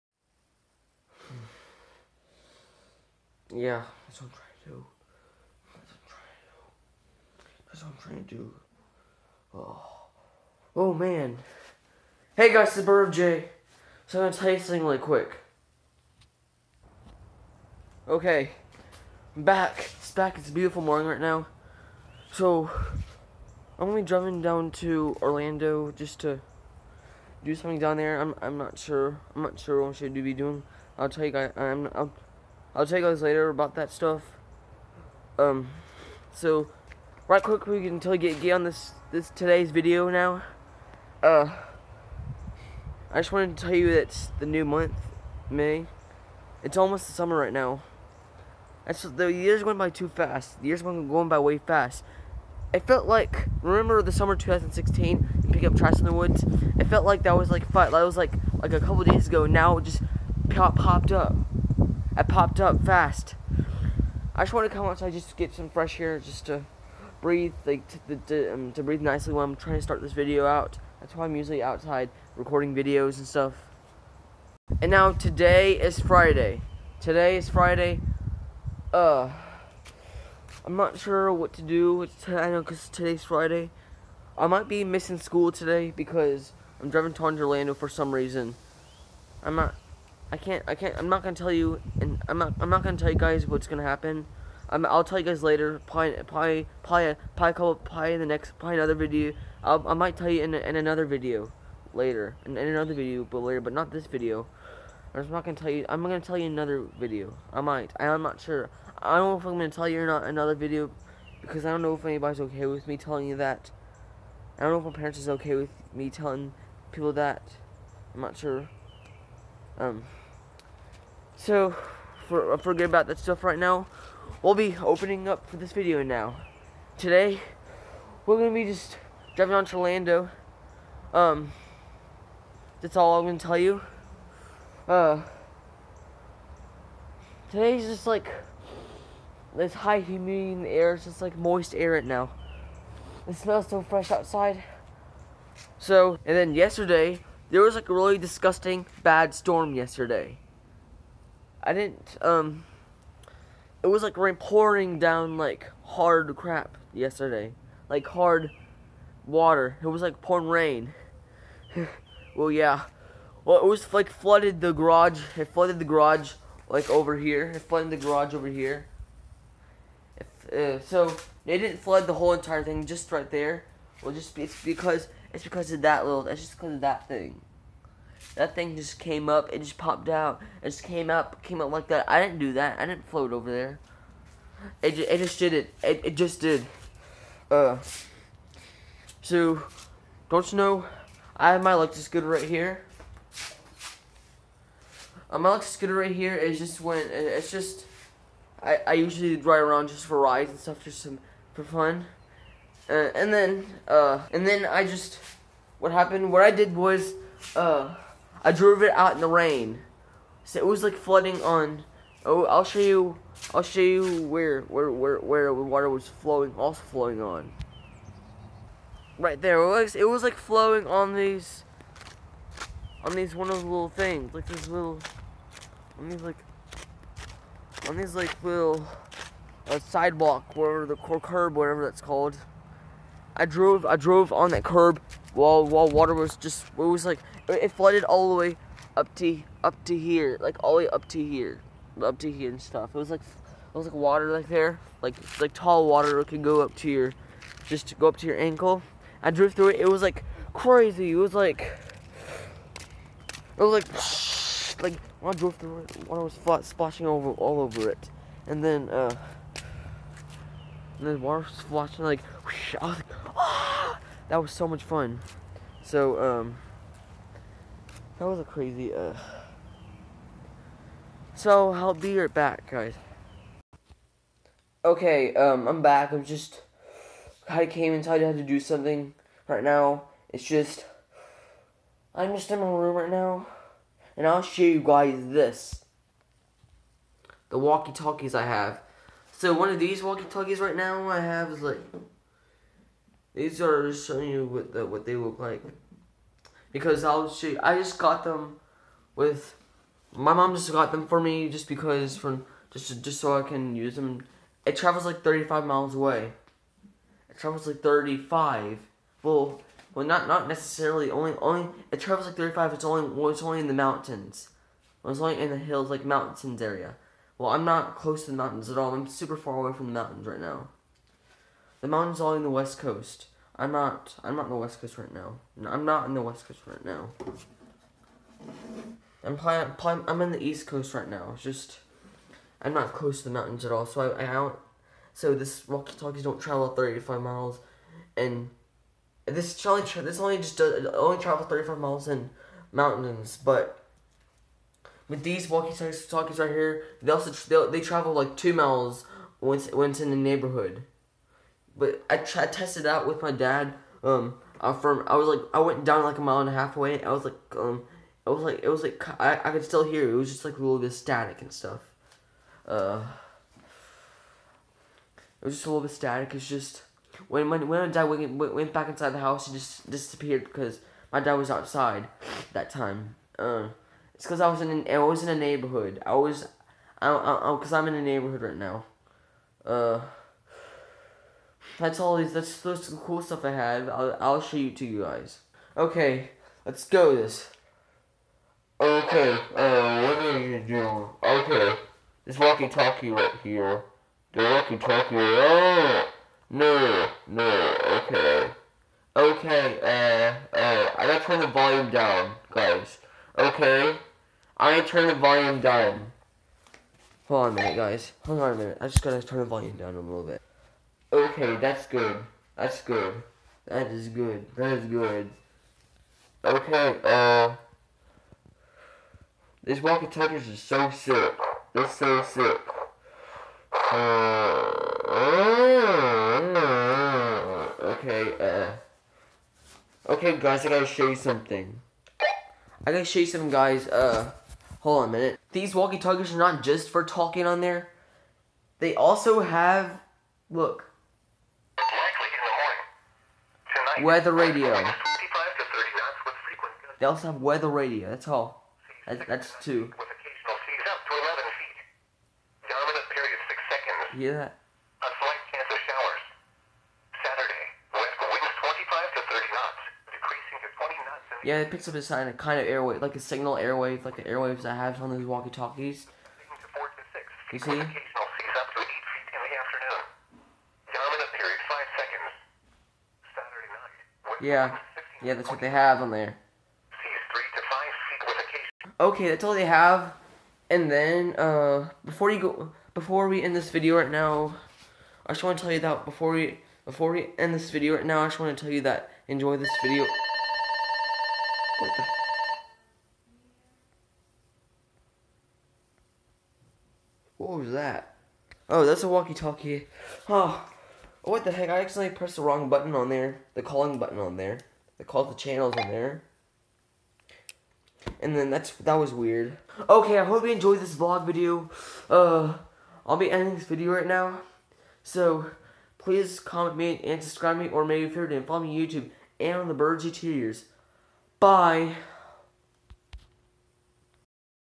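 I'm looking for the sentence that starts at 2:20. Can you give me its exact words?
It's just like moist air right now.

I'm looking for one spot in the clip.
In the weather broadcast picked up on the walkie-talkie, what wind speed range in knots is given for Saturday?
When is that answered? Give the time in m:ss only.
7:38.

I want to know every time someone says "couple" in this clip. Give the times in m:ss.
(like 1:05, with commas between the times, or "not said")
0:58, 1:37.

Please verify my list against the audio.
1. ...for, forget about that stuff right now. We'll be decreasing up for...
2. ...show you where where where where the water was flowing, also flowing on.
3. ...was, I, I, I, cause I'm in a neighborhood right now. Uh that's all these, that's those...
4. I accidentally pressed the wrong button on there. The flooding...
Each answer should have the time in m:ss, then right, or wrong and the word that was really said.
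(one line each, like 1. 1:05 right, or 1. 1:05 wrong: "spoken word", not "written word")
1. 2:02 wrong: "opening", not "decreasing"
2. 3:33 right
3. 6:16 right
4. 8:21 wrong: "calling", not "flooding".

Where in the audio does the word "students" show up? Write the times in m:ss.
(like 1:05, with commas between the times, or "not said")
not said.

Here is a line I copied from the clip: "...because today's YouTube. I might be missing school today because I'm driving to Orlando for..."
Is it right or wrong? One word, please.
wrong.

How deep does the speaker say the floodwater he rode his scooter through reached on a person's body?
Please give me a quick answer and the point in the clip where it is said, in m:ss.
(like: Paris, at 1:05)
ankle, at 4:08.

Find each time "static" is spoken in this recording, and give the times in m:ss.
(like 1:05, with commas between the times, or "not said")
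6:00, 6:05.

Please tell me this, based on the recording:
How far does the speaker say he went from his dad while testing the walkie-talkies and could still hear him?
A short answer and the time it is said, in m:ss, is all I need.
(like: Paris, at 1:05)
a mile and a half, at 5:56.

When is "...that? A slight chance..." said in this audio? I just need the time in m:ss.
7:34.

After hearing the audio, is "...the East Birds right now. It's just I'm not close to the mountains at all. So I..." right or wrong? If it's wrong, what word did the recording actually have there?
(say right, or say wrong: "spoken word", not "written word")
wrong: "Coast", not "Birds".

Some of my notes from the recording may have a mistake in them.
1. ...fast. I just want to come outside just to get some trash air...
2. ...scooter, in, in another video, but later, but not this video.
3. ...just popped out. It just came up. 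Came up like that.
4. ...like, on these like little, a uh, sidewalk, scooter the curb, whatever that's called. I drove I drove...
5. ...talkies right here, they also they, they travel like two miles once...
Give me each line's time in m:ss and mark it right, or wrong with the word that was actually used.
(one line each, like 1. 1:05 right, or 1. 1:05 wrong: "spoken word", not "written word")
1. 1:02 wrong: "fresh", not "trash"
2. 1:41 wrong: "later", not "scooter"
3. 2:59 right
4. 3:46 wrong: "whatever", not "scooter"
5. 5:45 right.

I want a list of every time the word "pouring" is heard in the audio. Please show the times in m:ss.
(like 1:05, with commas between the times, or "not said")
2:34, 2:40.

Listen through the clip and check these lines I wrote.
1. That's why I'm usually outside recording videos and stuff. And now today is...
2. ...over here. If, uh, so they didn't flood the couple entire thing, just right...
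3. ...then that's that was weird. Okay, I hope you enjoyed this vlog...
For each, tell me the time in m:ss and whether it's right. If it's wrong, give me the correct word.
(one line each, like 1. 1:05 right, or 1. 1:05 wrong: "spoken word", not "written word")
1. 1:10 right
2. 2:48 wrong: "whole", not "couple"
3. 8:28 right.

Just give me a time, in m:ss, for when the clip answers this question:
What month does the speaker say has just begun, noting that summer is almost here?
0:45.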